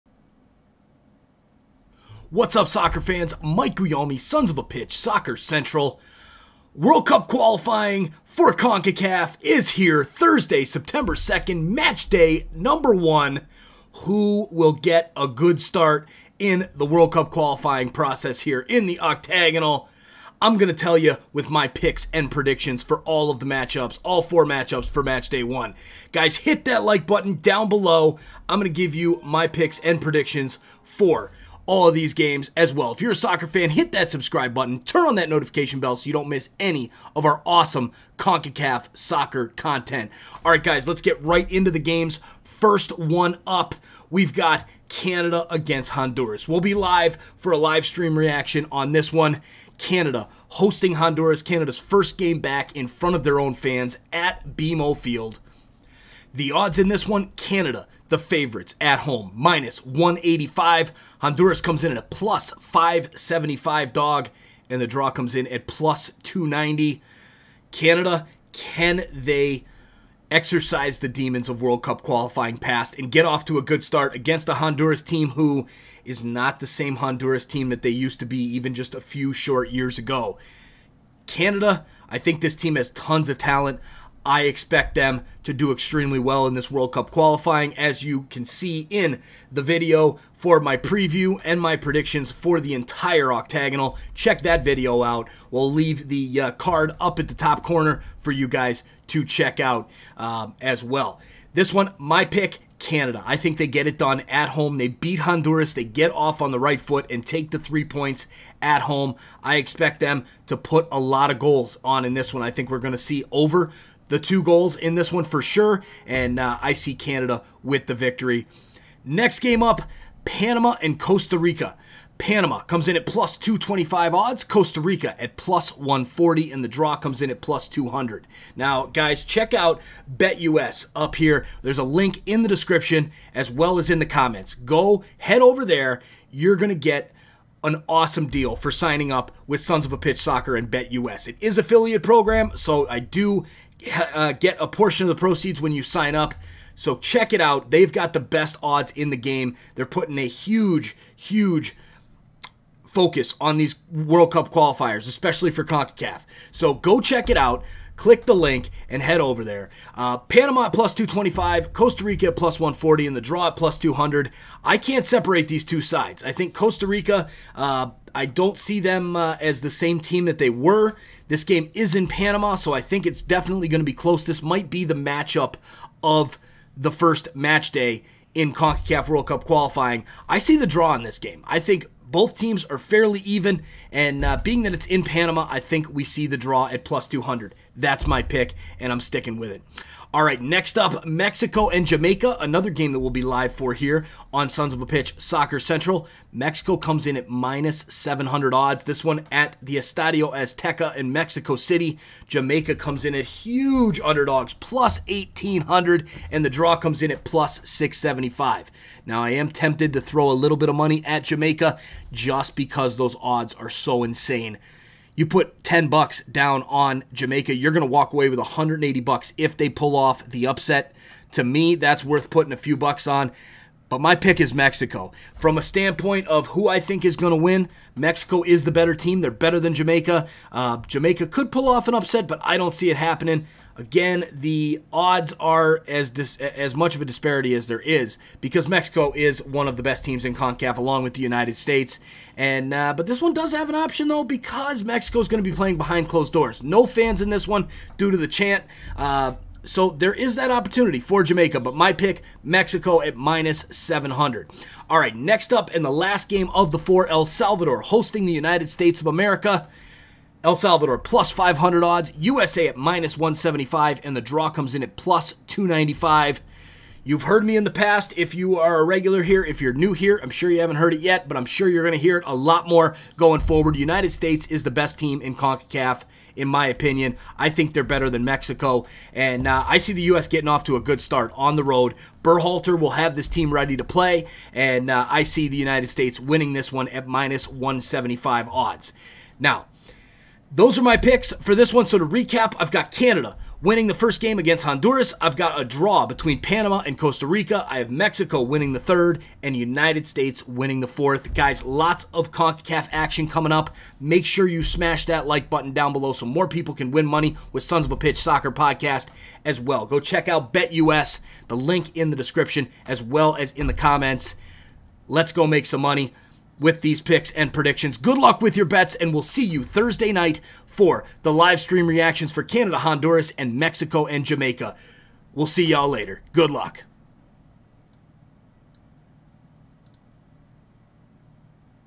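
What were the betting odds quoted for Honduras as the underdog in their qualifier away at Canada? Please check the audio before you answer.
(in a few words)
+575.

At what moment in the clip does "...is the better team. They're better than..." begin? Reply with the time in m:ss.
3:48.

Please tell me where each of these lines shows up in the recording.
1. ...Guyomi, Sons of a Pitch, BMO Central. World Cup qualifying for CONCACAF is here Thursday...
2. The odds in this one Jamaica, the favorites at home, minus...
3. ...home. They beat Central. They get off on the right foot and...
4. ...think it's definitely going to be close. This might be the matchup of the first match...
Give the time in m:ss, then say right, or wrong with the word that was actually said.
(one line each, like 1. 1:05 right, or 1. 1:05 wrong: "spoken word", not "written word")
1. 0:03 wrong: "Soccer", not "BMO"
2. 0:56 wrong: "Canada", not "Jamaica"
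3. 1:44 wrong: "Honduras", not "Central"
4. 2:52 right.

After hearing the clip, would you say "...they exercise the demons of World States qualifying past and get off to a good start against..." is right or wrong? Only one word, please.
wrong.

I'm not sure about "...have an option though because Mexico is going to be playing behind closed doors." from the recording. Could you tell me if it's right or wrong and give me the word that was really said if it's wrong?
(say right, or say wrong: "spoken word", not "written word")
right.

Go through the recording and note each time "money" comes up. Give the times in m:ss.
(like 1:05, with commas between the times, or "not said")
3:30, 5:07, 5:15.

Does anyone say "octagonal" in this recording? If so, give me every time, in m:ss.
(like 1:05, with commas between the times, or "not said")
0:19, 1:33.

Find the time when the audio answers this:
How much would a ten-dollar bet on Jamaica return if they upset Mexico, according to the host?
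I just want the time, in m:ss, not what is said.
3:38.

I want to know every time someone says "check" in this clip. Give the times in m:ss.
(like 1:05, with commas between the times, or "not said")
1:34, 1:39, 2:09, 2:26, 2:37, 5:10.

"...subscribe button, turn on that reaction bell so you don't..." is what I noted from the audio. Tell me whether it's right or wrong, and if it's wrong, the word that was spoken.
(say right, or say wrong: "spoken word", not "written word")
wrong: "notification", not "reaction".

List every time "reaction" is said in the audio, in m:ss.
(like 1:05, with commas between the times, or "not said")
0:48, 5:21.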